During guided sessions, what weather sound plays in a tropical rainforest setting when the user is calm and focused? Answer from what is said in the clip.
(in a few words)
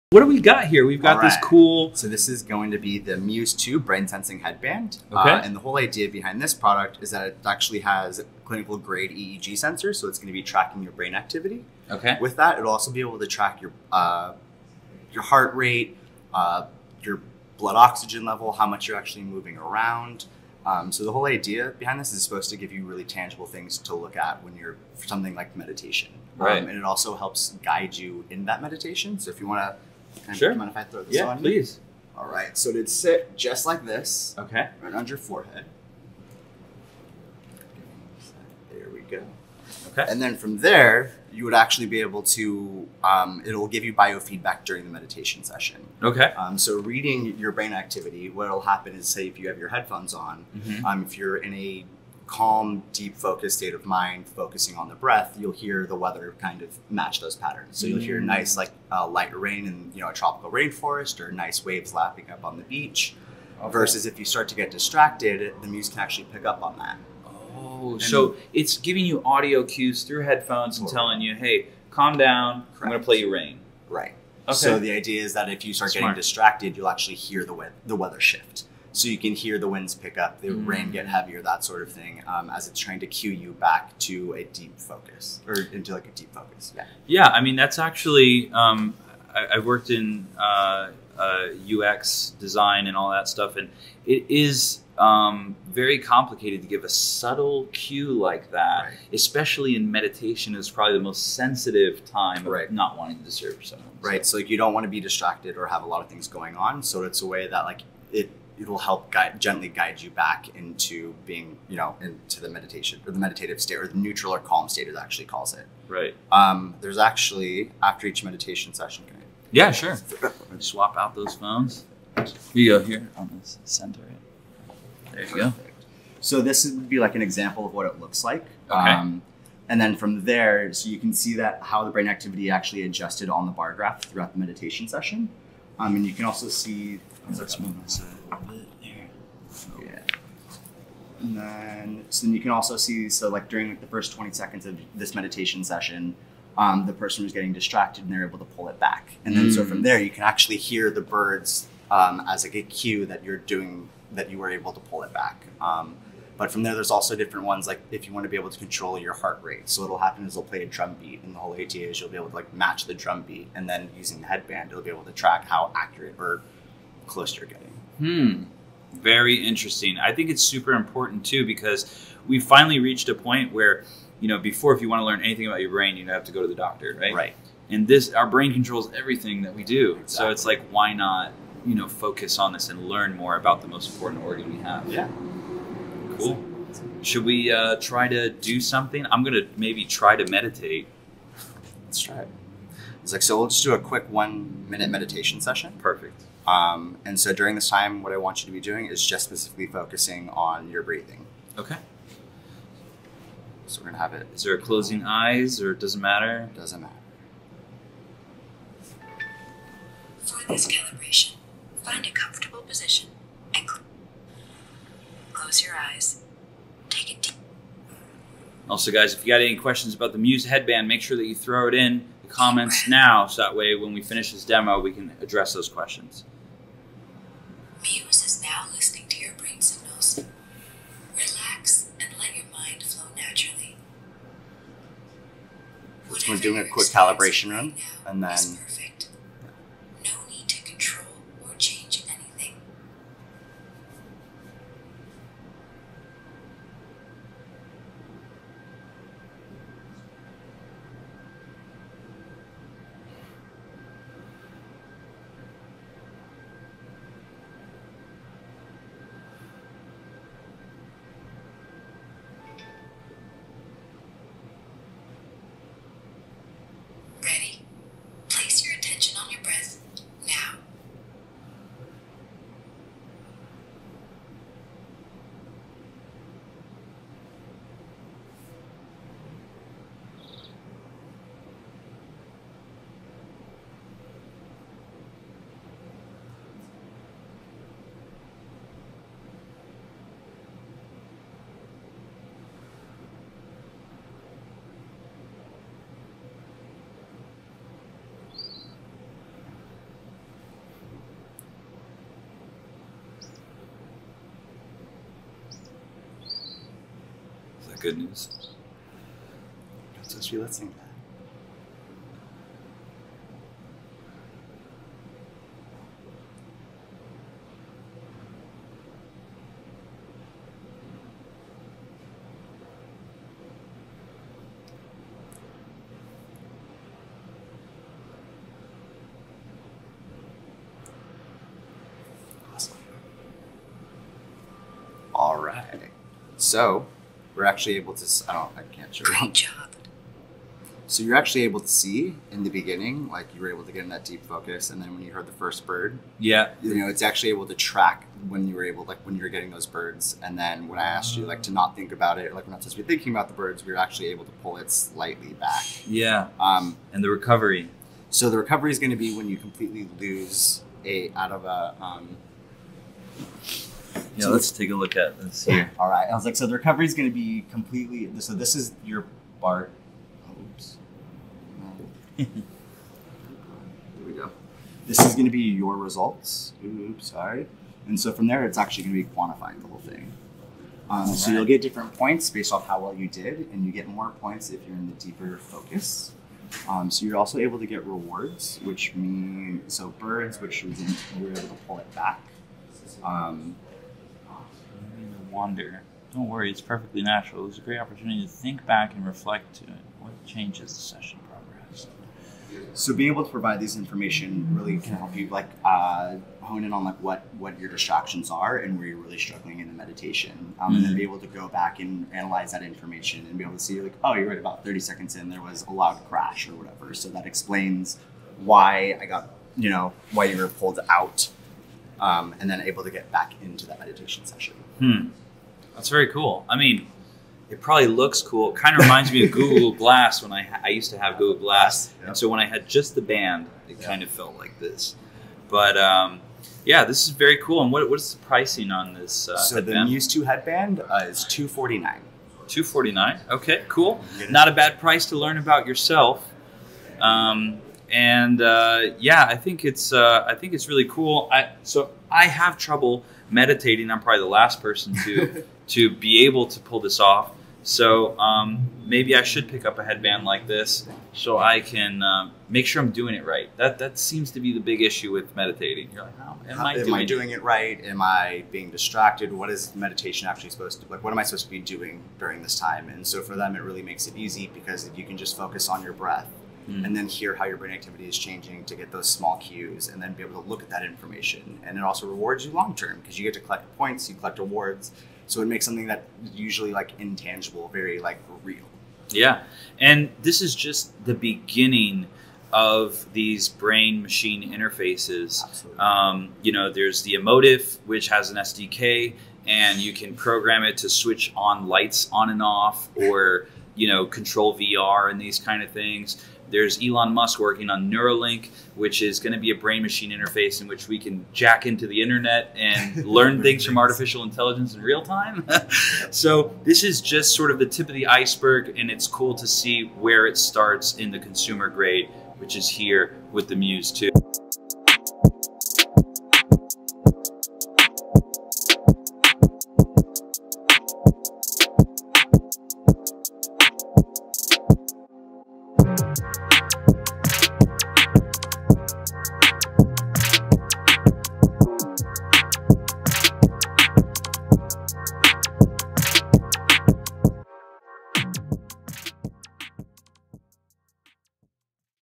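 light rain.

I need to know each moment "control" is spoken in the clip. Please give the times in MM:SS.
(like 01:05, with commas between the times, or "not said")
02:38, 02:58, 08:24.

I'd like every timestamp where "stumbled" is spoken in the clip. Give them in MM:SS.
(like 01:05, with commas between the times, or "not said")
not said.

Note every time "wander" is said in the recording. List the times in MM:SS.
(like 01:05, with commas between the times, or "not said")
06:35.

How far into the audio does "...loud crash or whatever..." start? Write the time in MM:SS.
06:55.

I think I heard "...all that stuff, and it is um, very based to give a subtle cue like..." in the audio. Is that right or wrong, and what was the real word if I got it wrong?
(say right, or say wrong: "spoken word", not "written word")
wrong: "complicated", not "based".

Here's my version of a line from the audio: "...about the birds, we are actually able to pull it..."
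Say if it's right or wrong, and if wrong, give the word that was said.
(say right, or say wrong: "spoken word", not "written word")
right.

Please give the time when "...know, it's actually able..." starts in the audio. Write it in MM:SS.
05:46.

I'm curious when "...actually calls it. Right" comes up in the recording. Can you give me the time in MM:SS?
01:54.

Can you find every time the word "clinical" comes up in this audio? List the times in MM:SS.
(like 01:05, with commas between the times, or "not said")
00:08.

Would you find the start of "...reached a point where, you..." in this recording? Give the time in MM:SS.
02:52.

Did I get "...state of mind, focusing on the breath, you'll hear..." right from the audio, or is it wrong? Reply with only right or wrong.
right.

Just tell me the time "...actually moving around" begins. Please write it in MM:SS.
00:18.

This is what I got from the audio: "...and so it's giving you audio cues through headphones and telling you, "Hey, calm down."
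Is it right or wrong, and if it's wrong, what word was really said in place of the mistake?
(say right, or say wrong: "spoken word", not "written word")
right.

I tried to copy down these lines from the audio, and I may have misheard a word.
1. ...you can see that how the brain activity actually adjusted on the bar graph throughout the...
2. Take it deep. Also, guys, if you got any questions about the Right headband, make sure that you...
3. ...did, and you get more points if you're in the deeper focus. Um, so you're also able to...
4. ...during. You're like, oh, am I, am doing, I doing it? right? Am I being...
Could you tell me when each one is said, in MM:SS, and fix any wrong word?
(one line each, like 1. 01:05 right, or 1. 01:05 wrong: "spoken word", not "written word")
1. 02:10 right
2. 03:36 wrong: "Muse", not "Right"
3. 06:23 right
4. 07:45 wrong: "meditating", not "during".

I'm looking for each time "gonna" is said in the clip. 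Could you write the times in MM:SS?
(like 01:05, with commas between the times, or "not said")
03:09, 03:23.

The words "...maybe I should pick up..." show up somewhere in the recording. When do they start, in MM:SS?
07:38.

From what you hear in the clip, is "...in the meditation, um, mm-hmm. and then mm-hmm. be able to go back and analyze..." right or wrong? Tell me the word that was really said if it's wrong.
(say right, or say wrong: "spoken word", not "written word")
right.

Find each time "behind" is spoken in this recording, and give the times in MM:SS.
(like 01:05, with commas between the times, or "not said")
00:06, 00:21.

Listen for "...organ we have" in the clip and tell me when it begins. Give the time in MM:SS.
03:04.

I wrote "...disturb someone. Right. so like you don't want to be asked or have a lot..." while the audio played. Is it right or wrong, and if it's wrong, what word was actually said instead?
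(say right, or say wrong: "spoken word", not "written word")
wrong: "distracted", not "asked".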